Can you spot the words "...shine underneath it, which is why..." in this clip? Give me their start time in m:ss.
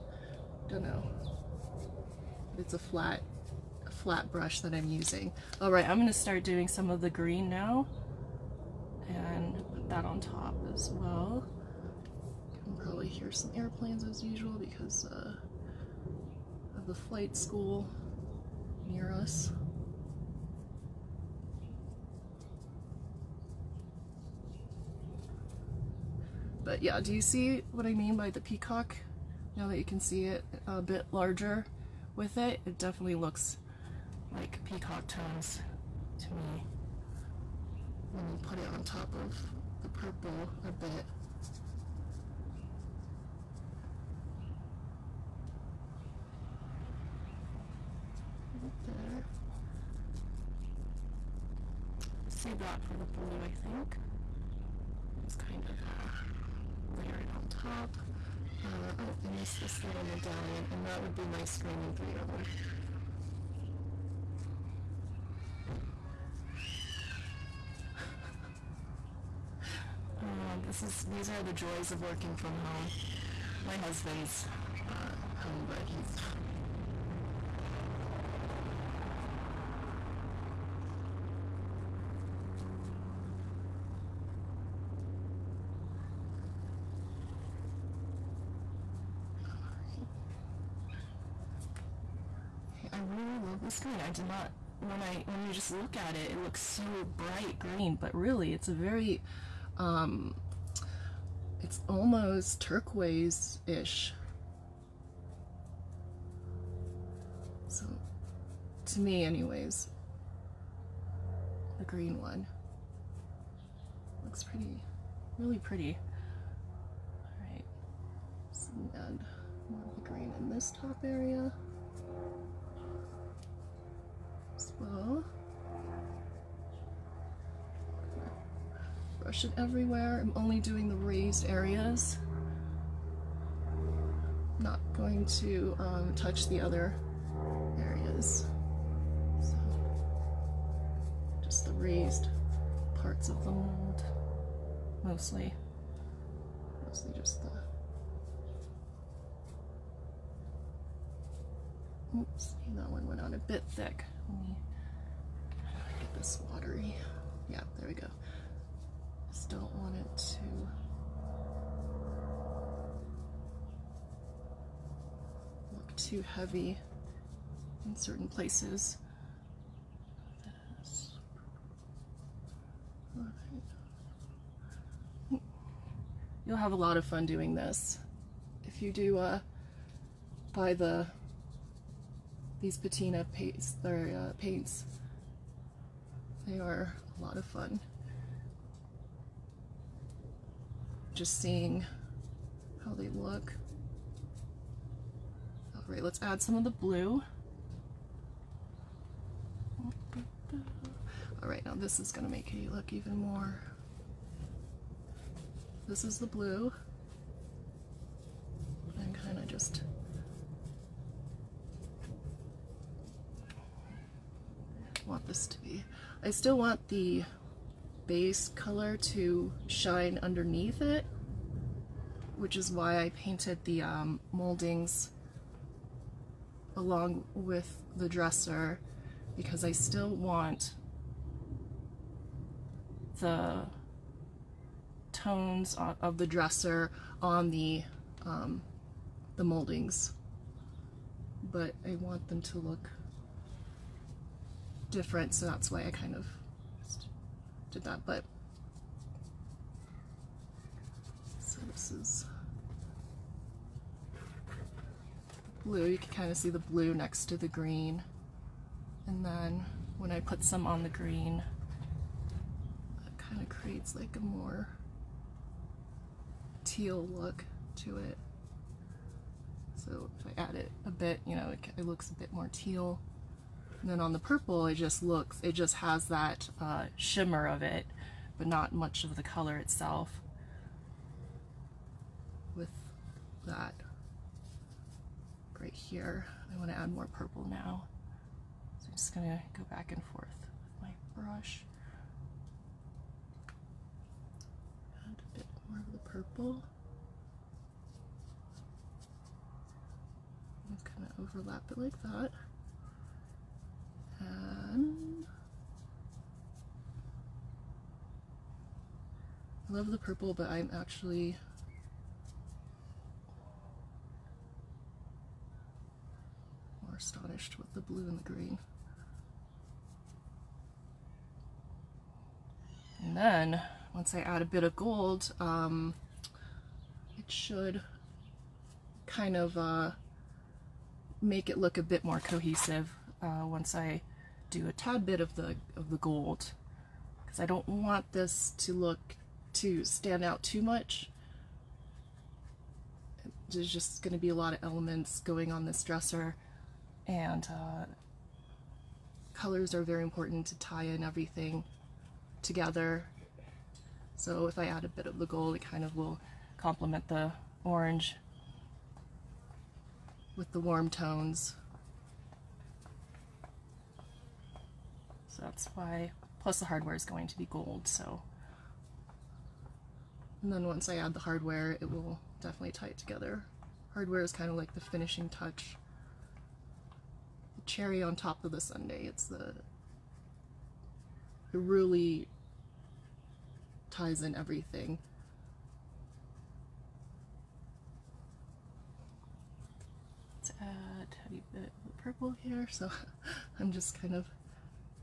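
3:39.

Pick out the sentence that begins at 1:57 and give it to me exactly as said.
All right, so add more of the green in this top area.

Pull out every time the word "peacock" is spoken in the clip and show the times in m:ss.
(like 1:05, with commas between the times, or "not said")
0:28, 0:34.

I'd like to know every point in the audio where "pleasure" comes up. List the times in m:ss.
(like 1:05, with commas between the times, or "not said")
not said.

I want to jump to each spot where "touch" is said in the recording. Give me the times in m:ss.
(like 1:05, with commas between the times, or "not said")
2:16, 6:15.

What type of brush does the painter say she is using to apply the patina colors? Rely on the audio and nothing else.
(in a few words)
flat brush.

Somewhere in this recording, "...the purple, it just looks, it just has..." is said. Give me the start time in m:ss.
4:34.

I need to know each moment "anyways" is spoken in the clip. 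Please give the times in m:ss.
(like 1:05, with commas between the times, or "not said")
1:49.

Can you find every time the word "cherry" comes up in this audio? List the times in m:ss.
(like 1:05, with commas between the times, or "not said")
6:17.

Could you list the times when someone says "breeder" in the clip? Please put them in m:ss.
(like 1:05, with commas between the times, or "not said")
not said.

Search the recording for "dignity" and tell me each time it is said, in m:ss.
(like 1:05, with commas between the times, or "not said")
not said.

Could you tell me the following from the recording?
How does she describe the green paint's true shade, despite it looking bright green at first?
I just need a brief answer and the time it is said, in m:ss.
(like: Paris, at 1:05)
turquoise-ish, at 1:42.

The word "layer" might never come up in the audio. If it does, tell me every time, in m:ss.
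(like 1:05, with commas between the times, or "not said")
0:56.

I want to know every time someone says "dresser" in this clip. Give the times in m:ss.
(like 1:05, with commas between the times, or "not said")
3:48, 3:56, 5:45.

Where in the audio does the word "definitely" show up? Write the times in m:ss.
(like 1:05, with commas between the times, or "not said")
0:32, 6:12.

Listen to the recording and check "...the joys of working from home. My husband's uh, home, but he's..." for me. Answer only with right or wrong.
right.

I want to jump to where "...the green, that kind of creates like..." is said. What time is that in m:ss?
4:20.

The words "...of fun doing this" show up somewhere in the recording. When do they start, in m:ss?
2:56.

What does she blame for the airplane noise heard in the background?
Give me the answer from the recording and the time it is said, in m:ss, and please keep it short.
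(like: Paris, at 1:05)
flight school, at 0:16.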